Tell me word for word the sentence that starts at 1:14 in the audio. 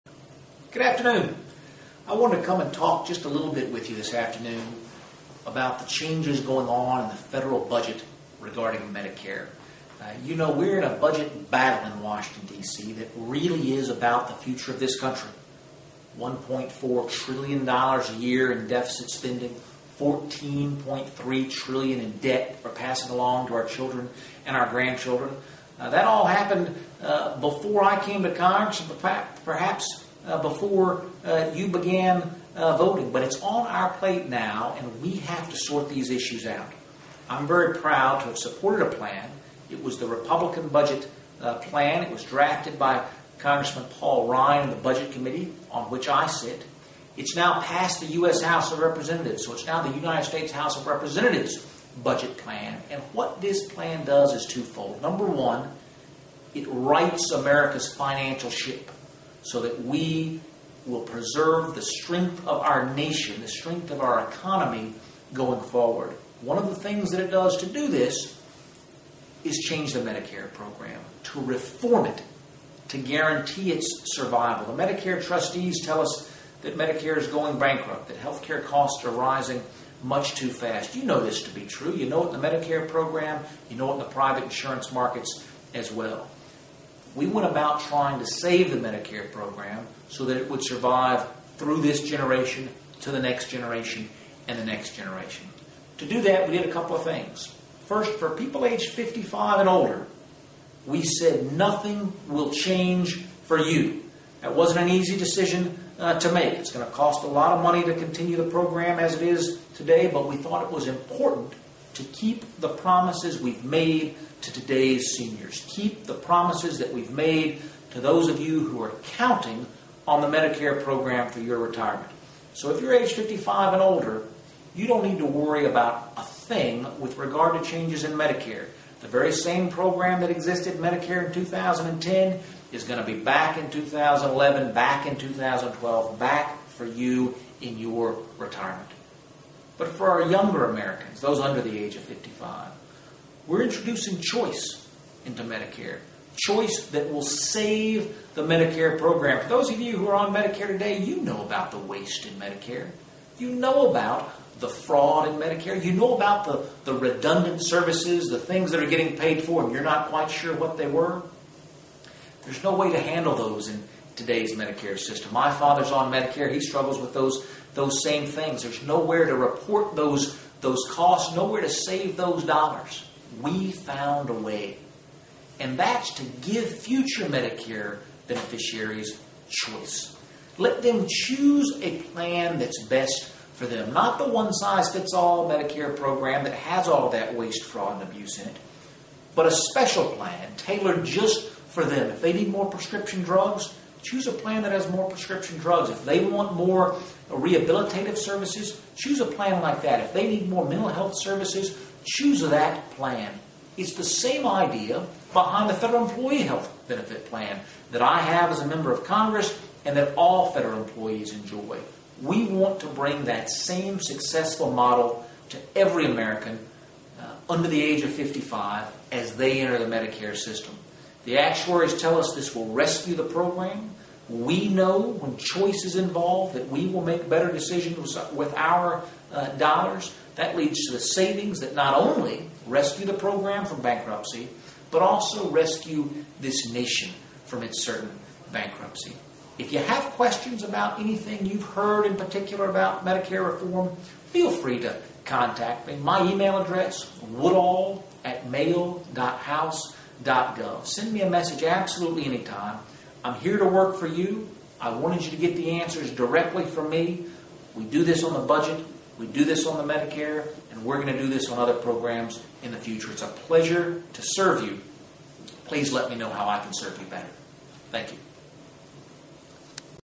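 The Medicare trustees tell us that Medicare is going bankrupt, that health care costs are rising much too fast.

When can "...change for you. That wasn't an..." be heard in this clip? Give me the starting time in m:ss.
1:42.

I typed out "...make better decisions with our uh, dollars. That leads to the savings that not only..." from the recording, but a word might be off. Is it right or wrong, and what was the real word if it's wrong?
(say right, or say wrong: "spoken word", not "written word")
right.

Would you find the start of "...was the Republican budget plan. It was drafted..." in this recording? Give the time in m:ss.
0:39.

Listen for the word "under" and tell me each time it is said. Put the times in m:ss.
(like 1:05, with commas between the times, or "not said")
2:21, 3:37.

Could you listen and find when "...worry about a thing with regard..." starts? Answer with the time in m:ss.
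2:05.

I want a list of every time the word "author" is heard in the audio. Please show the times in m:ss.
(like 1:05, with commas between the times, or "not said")
not said.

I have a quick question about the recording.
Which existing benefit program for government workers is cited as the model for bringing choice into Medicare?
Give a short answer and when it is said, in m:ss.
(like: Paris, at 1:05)
federal employee health benefit plan, at 3:25.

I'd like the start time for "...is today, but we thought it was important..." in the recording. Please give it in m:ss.
1:49.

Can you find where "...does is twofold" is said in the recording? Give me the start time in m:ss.
0:54.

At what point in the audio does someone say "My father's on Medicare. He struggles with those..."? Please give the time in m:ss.
2:45.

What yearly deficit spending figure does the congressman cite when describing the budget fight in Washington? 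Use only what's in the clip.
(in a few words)
$1.4 trillion.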